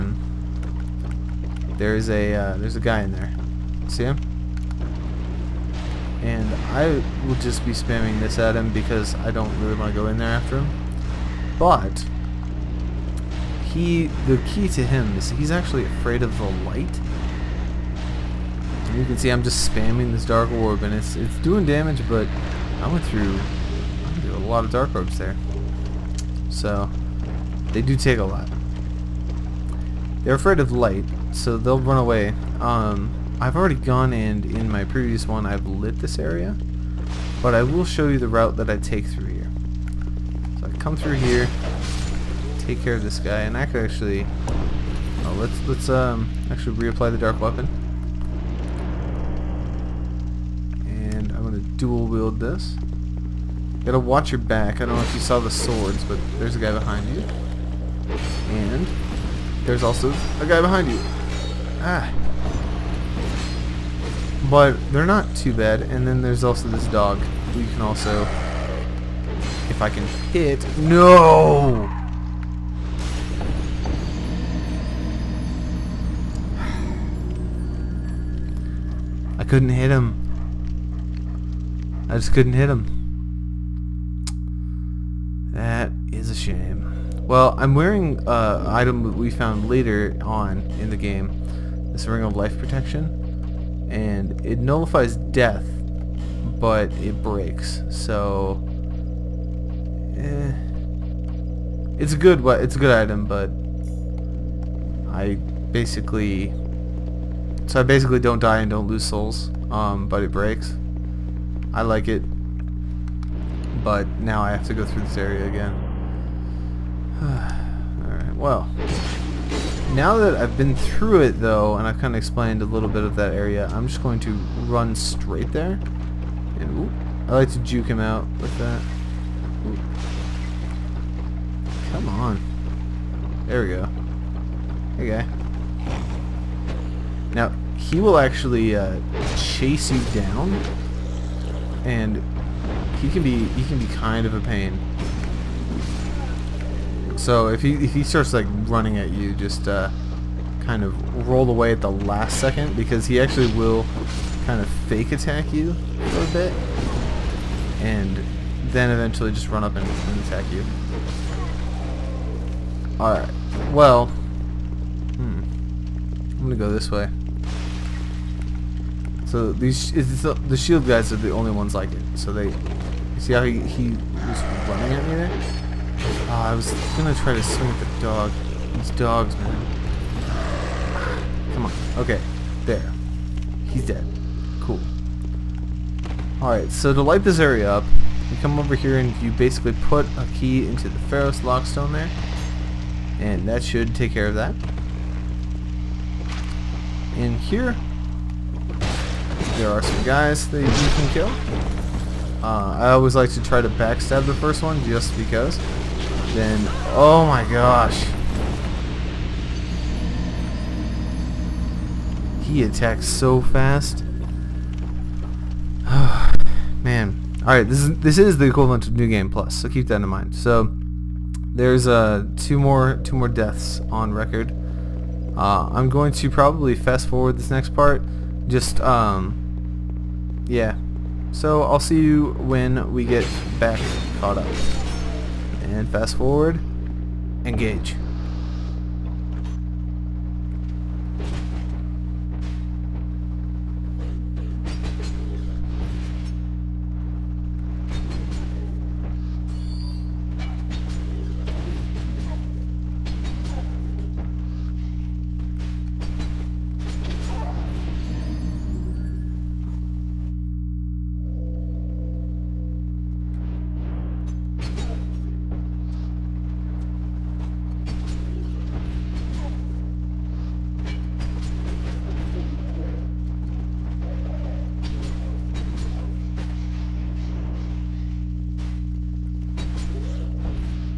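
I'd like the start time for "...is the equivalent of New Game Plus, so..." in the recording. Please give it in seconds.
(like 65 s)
218 s.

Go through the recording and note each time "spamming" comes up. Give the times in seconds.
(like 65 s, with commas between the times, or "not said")
7 s, 19 s.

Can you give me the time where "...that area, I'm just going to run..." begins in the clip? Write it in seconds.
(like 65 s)
123 s.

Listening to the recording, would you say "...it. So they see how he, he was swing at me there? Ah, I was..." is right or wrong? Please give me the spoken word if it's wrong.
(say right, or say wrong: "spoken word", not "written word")
wrong: "running", not "swing".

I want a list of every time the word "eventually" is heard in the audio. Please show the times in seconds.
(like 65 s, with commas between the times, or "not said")
158 s.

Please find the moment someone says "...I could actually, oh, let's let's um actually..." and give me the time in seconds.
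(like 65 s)
43 s.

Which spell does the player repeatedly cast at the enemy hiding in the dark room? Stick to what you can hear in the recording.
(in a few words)
Dark Orb.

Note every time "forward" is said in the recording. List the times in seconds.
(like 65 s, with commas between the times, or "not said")
227 s, 236 s.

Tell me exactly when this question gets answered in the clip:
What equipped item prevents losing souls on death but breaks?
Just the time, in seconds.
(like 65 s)
92 s.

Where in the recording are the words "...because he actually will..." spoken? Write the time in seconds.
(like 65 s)
152 s.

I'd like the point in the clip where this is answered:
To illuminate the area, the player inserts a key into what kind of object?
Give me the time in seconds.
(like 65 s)
190 s.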